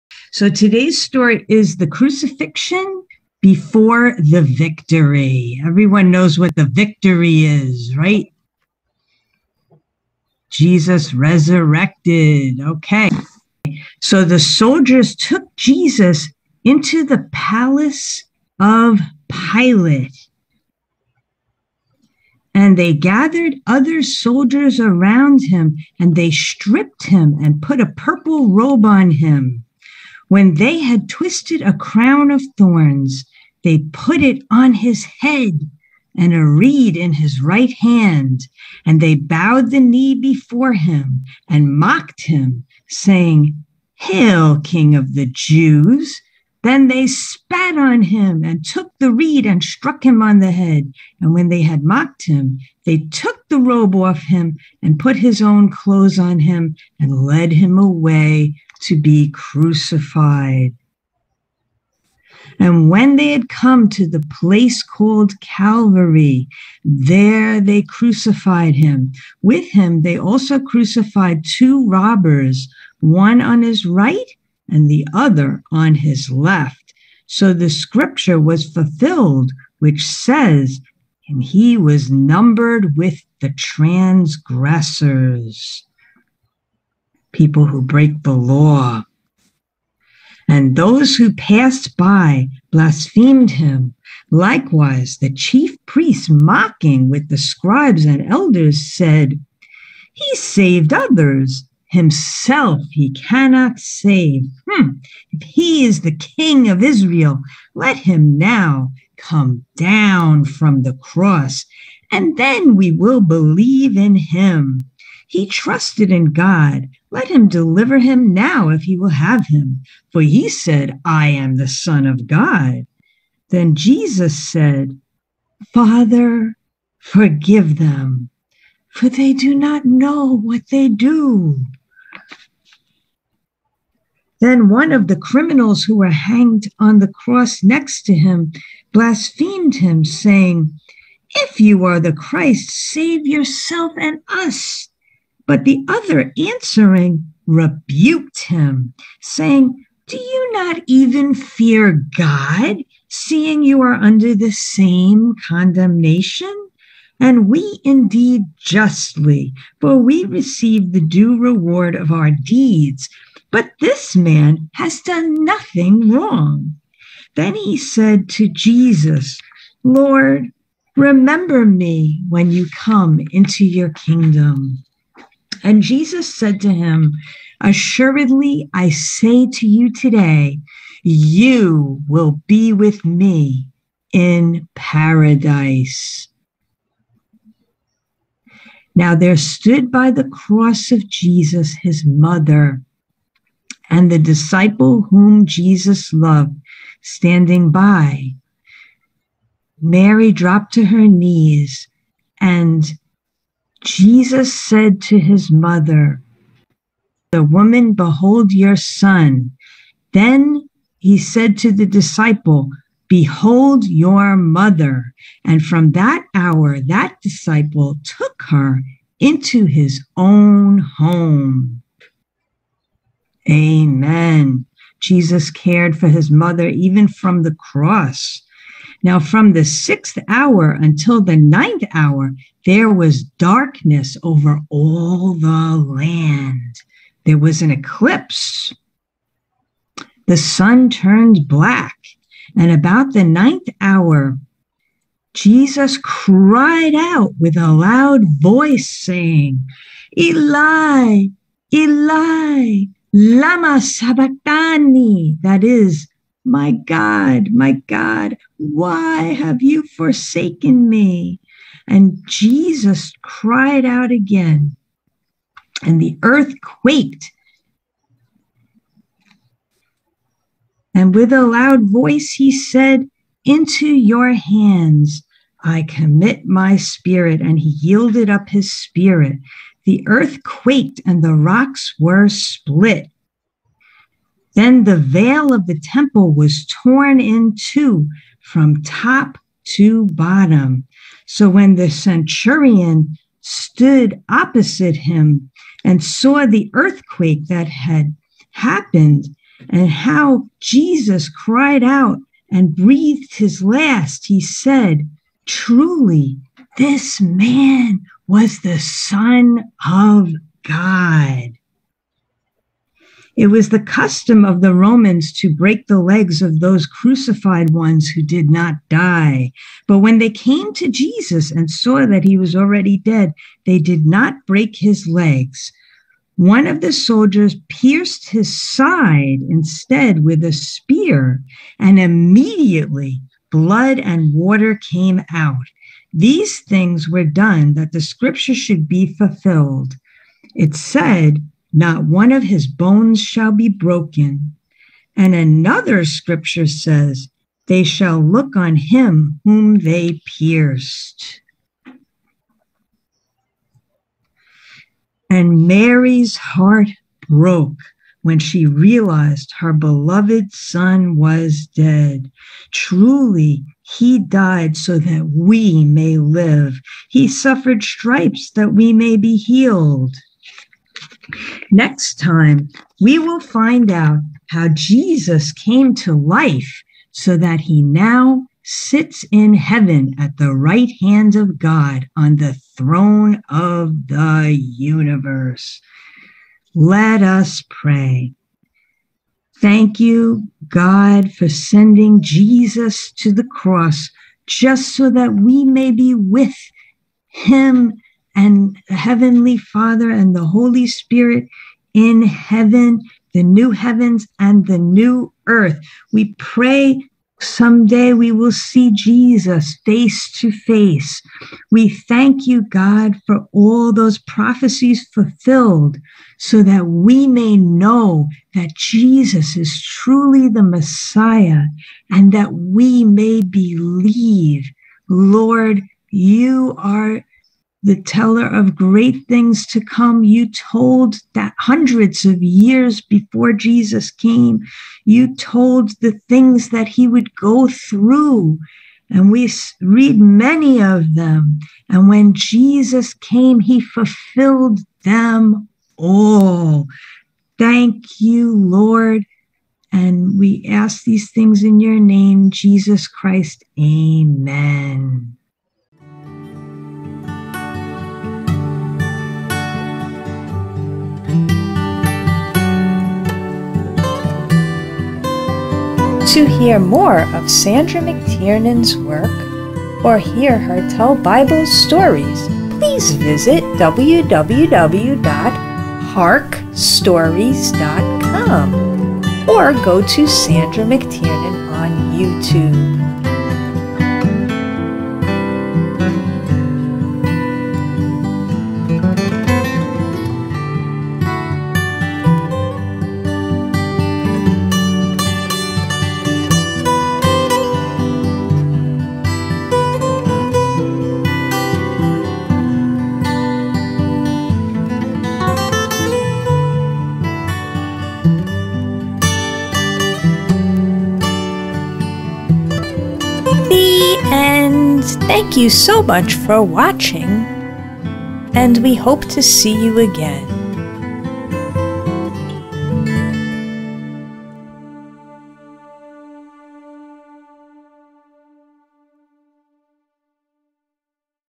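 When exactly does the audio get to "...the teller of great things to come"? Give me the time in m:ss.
7:07.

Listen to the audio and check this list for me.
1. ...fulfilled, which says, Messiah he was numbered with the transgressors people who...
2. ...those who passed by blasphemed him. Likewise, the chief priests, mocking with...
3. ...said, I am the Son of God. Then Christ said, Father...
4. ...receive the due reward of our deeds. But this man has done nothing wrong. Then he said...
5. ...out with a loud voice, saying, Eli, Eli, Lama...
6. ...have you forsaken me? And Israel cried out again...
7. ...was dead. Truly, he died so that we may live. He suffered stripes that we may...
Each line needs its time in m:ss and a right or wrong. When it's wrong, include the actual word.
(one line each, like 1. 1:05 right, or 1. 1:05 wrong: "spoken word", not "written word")
1. 1:18 wrong: "And", not "Messiah"
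2. 1:30 right
3. 2:00 wrong: "Jesus", not "Christ"
4. 2:40 right
5. 4:06 right
6. 4:19 wrong: "Jesus", not "Israel"
7. 6:01 right.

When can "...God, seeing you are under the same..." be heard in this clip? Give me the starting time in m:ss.
2:32.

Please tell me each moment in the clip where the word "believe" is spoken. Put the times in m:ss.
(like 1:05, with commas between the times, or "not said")
1:53, 7:03.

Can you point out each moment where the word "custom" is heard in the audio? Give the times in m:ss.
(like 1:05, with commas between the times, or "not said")
5:13.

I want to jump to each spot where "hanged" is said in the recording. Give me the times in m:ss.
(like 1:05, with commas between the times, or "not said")
2:16.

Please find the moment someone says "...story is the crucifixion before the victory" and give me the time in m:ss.
0:01.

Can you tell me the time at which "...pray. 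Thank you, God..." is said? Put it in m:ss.
6:27.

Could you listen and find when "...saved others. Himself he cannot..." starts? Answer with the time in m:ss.
1:40.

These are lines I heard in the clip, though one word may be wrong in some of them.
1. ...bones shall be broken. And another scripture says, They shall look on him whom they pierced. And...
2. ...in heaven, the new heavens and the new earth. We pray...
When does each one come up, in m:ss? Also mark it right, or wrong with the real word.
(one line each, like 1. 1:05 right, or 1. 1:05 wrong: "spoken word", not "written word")
1. 5:42 right
2. 6:41 right.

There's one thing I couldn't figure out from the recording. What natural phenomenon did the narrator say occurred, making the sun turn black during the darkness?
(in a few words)
An eclipse.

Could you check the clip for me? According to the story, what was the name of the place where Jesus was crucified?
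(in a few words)
Calvary.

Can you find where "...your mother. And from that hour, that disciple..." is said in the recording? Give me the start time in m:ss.
3:33.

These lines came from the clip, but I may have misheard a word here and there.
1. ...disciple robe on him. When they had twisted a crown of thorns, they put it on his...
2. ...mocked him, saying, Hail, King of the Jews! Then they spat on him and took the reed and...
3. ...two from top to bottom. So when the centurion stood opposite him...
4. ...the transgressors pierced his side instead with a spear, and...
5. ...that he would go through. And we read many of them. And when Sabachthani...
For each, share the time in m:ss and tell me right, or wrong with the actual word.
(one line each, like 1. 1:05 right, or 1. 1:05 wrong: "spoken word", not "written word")
1. 0:27 wrong: "purple", not "disciple"
2. 0:41 right
3. 4:47 right
4. 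5:26 wrong: "soldiers", not "transgressors"
5. 7:16 wrong: "Jesus", not "Sabachthani".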